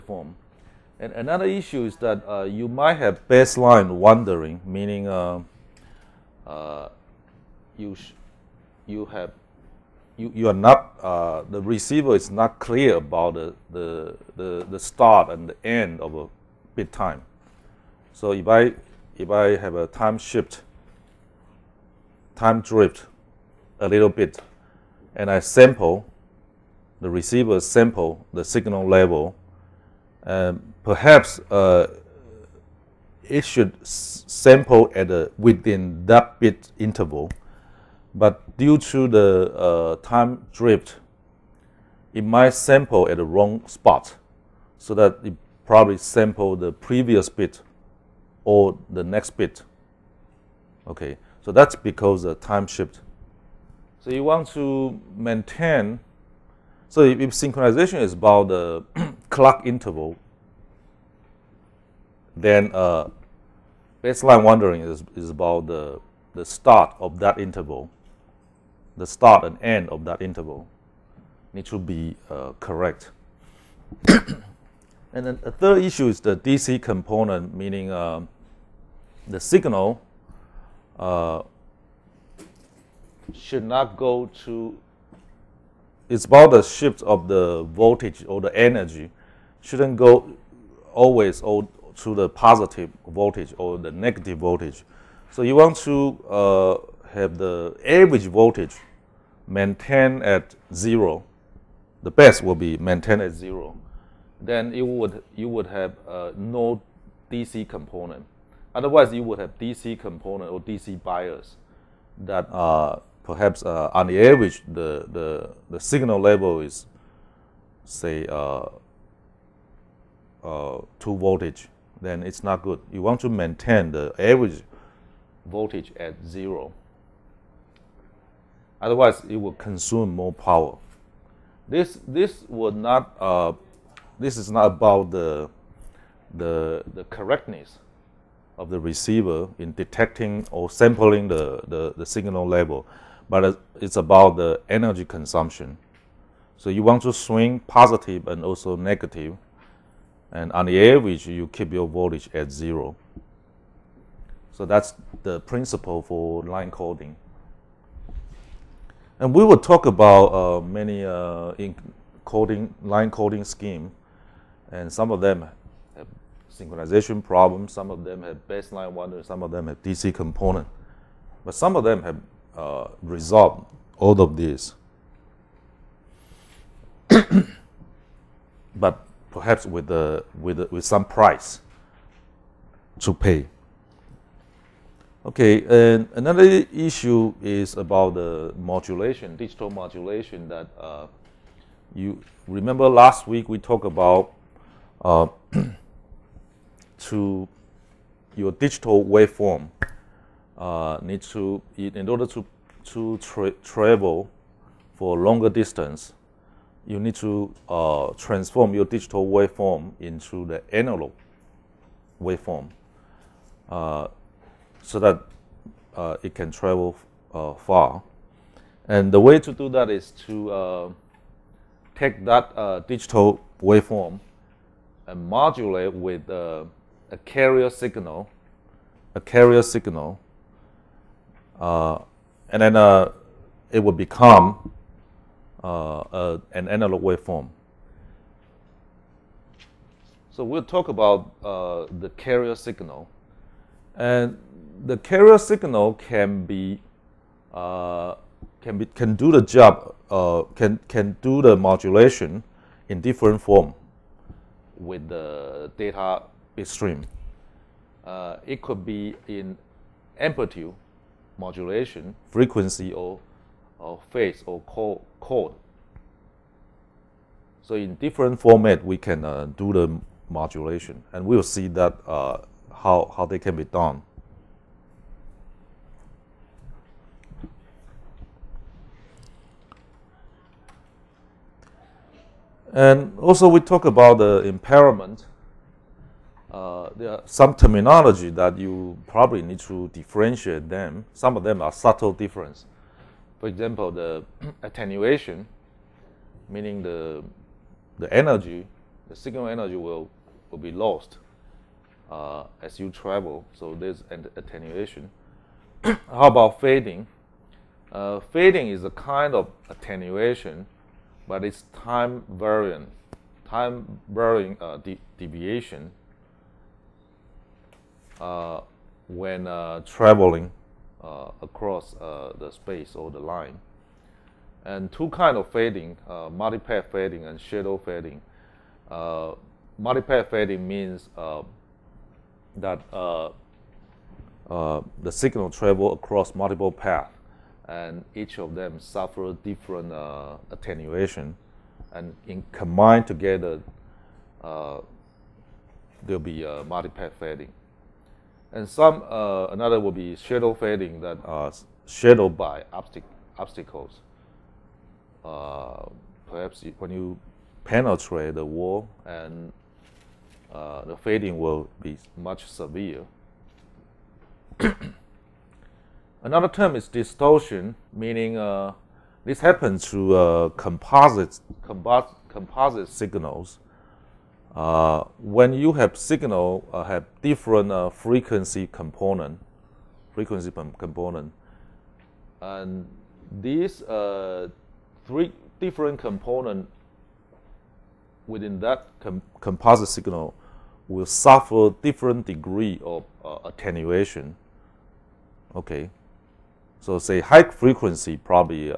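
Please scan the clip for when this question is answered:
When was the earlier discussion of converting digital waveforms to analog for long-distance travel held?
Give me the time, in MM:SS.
03:12.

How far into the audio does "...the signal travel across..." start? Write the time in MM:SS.
05:34.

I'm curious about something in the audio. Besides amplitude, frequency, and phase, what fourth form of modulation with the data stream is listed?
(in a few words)
code.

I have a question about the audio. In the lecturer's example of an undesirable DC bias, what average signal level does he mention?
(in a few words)
2 voltage.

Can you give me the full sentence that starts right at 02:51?
But some of them have uh, resolved all of these.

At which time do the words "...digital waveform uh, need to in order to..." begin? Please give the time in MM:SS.
03:18.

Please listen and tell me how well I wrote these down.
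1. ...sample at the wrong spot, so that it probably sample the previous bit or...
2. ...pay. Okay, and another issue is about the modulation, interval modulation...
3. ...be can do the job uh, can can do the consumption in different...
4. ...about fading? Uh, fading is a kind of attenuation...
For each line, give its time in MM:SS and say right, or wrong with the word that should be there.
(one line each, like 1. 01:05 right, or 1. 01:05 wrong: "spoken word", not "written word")
1. 00:42 right
2. 03:03 wrong: "digital", not "interval"
3. 04:08 wrong: "modulation", not "consumption"
4. 05:06 right.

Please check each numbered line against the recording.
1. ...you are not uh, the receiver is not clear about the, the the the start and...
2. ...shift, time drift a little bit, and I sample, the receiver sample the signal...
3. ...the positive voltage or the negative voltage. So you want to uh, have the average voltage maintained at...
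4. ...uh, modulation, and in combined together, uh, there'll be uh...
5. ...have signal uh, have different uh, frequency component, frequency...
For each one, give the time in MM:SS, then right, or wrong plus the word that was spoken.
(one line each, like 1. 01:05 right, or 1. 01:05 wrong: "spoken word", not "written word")
1. 00:10 right
2. 00:20 right
3. 01:32 right
4. 05:39 wrong: "attenuation", not "modulation"
5. 06:15 right.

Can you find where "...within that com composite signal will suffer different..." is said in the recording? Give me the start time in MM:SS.
06:28.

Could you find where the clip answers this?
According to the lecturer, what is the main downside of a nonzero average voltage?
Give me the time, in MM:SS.
02:09.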